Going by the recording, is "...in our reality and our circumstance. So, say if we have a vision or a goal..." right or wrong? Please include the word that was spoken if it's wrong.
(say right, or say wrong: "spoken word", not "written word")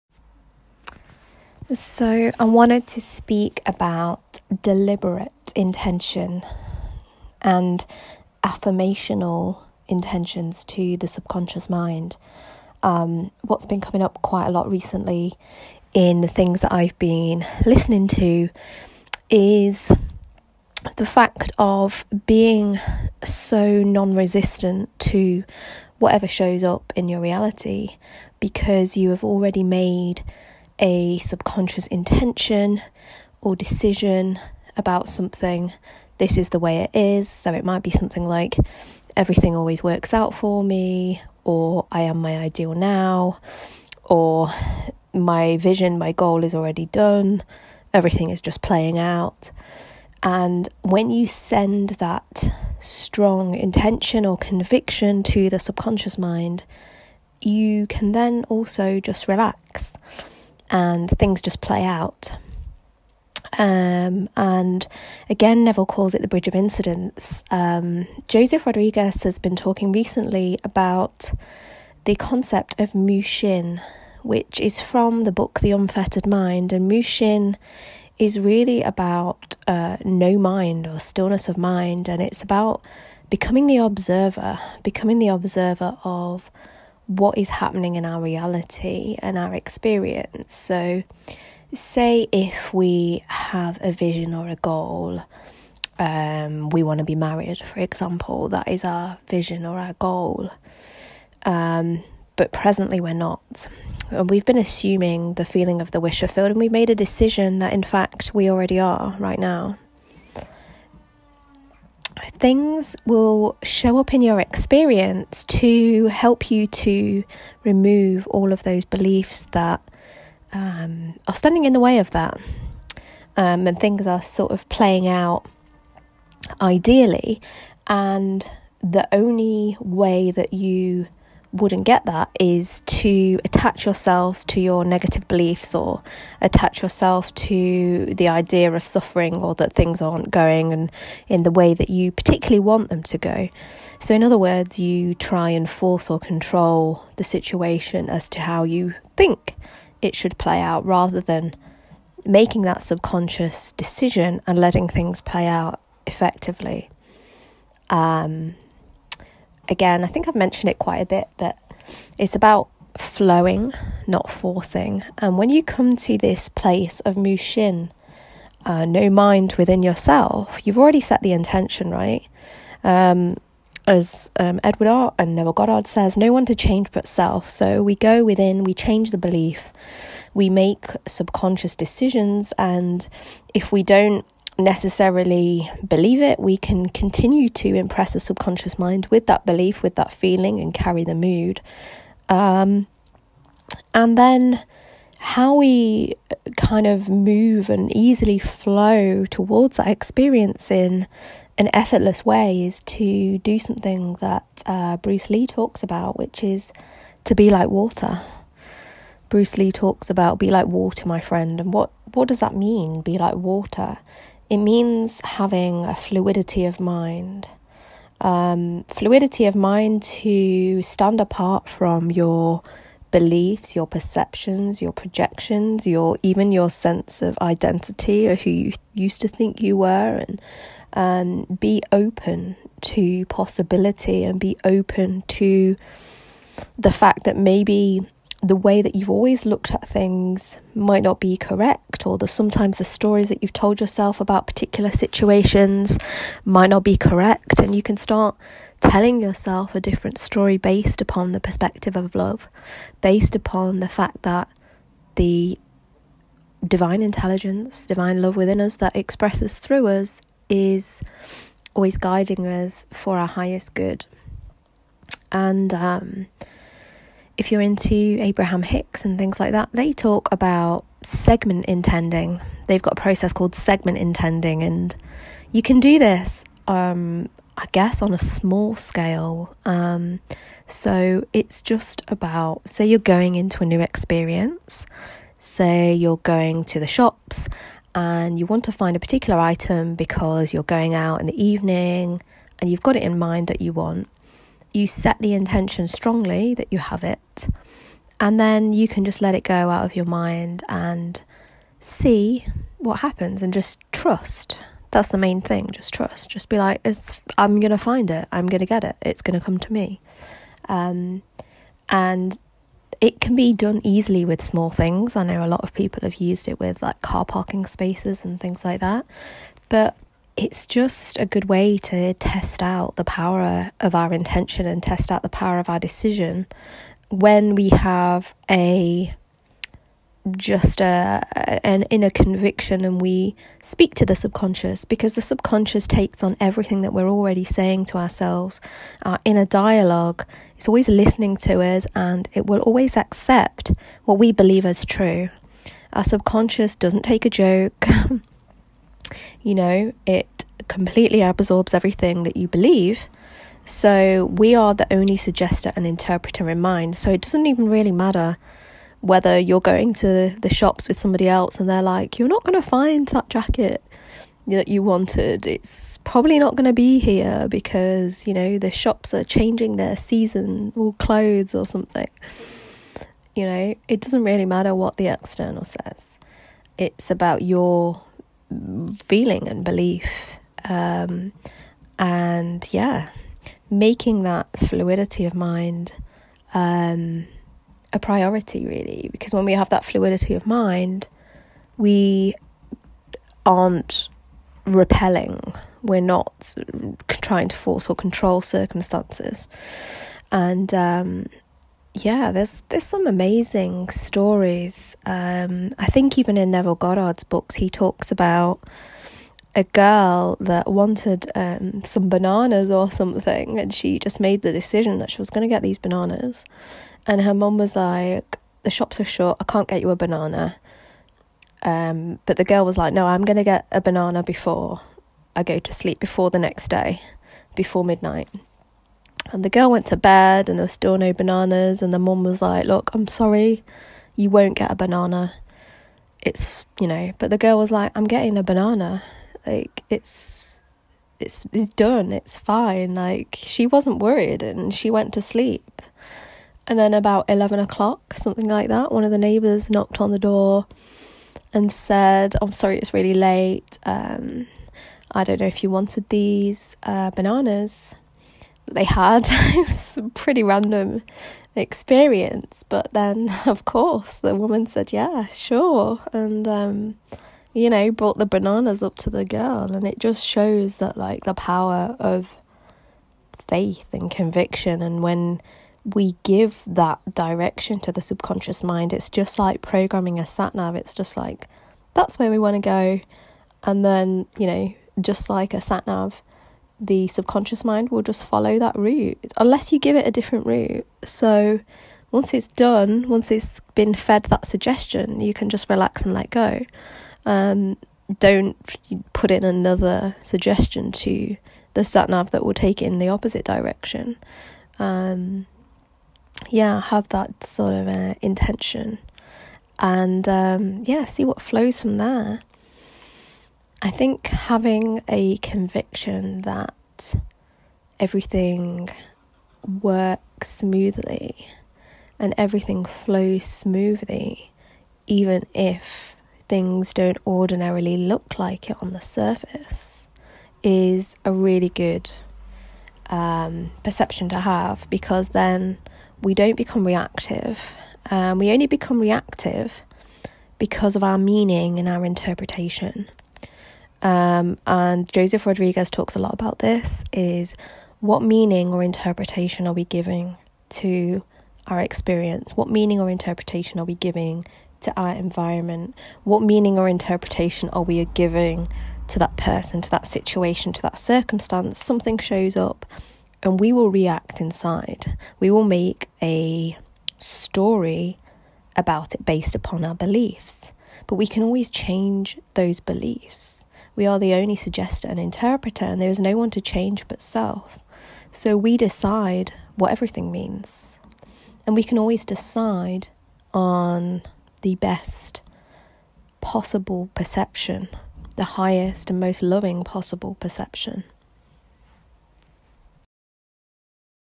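wrong: "experience", not "circumstance".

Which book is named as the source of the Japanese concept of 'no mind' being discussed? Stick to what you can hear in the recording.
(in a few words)
The Unfettered Mind.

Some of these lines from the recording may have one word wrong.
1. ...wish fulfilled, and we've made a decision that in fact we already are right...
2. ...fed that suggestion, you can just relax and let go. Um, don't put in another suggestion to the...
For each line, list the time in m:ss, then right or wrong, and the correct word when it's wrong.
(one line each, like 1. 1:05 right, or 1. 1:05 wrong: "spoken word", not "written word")
1. 1:45 right
2. 8:13 right.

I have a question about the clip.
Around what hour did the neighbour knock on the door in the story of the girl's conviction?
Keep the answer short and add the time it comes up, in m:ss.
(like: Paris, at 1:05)
11 o'clock, at 7:27.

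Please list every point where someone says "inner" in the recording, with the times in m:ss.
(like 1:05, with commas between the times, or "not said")
5:31, 5:39.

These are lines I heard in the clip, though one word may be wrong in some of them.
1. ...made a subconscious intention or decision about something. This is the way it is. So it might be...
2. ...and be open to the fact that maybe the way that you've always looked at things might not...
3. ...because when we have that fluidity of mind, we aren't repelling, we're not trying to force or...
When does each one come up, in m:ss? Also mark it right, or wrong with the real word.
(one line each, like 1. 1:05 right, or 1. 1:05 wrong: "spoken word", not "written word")
1. 0:29 right
2. 3:54 right
3. 6:29 right.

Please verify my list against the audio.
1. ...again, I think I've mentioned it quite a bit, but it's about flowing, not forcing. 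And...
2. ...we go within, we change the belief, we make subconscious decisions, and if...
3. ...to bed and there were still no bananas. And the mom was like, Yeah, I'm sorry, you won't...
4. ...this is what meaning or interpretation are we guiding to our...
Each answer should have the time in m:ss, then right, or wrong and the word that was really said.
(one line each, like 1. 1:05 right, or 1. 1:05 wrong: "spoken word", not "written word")
1. 2:39 right
2. 2:57 right
3. 7:09 wrong: "Look", not "Yeah"
4. 9:06 wrong: "giving", not "guiding".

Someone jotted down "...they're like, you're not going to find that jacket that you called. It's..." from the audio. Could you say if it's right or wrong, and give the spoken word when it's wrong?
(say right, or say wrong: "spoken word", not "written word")
wrong: "wanted", not "called".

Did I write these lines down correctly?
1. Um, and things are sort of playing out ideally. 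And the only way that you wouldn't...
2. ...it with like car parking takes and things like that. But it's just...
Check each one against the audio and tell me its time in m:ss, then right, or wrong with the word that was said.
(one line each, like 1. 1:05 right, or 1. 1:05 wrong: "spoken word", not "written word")
1. 2:03 right
2. 5:16 wrong: "spaces", not "takes".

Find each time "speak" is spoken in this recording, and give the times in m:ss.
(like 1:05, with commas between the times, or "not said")
0:03, 5:33.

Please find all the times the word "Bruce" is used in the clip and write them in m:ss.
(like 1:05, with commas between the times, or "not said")
3:24, 3:29.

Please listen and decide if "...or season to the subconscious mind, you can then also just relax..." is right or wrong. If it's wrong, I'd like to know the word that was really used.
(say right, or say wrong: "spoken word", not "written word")
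wrong: "conviction", not "season".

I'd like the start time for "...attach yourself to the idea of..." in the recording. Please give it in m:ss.
2:16.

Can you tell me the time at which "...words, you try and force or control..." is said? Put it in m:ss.
2:24.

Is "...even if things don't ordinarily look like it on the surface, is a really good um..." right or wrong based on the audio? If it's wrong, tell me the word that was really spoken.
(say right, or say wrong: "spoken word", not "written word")
right.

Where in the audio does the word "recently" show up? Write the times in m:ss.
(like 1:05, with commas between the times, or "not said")
0:14, 1:09.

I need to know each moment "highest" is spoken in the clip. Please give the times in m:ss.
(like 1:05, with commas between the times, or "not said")
4:23, 9:48.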